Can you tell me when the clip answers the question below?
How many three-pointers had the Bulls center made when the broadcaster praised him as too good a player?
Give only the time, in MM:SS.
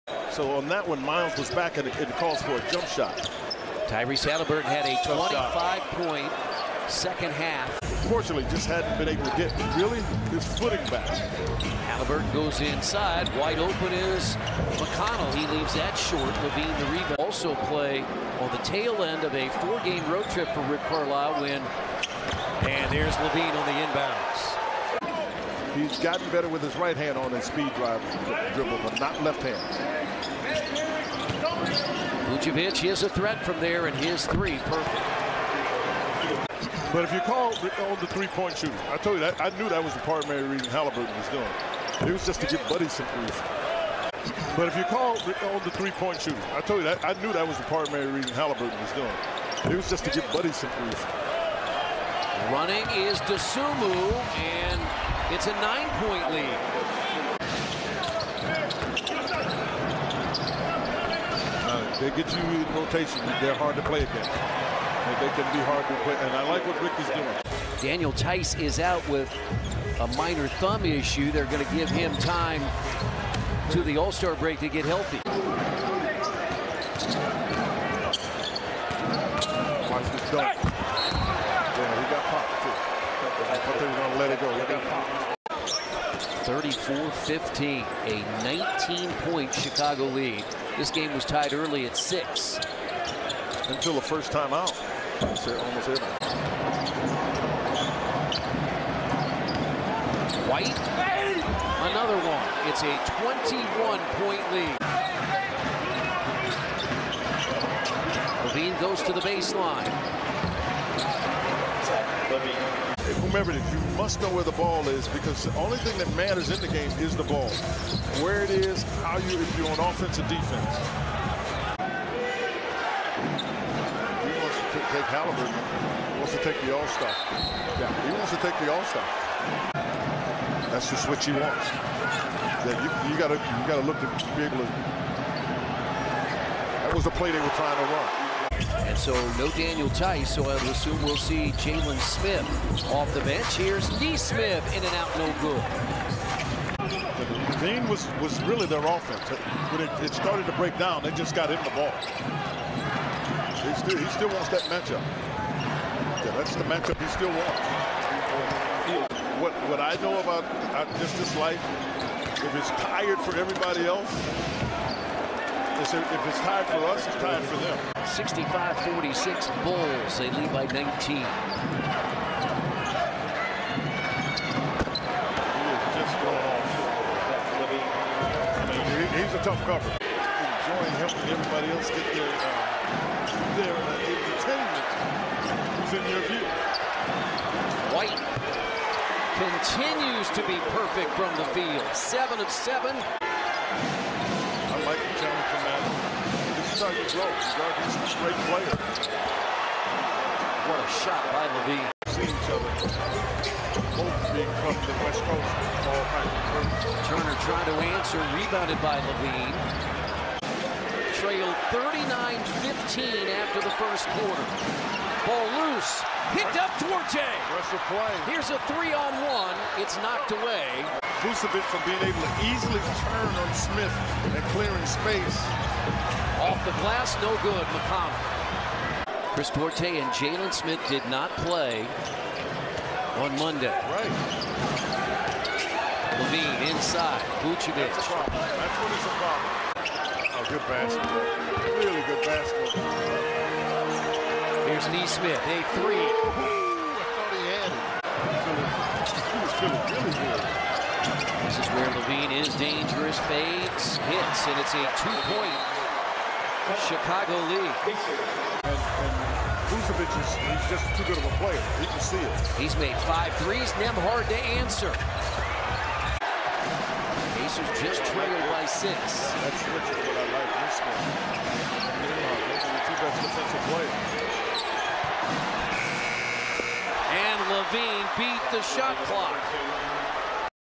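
04:23.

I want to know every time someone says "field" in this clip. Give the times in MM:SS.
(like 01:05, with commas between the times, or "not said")
03:11.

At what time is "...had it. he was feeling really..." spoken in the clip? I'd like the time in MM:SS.
04:09.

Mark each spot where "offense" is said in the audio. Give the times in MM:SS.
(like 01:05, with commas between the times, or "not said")
01:59, 02:28.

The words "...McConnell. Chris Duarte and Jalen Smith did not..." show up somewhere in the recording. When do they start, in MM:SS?
03:47.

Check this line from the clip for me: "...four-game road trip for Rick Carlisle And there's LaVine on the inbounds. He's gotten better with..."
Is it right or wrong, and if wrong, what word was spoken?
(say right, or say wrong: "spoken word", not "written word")
right.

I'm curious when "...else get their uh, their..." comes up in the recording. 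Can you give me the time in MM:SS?
03:01.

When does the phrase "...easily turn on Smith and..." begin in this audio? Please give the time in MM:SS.
03:42.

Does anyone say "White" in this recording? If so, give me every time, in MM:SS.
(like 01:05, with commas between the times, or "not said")
01:40, 03:07.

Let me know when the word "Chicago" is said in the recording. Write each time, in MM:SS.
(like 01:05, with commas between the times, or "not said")
01:29, 04:16.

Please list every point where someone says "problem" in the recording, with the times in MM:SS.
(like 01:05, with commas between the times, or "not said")
03:59.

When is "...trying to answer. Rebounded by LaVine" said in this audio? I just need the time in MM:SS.
03:27.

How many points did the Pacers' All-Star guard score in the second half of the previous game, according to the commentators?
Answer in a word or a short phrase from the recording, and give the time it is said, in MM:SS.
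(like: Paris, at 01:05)
25, at 00:05.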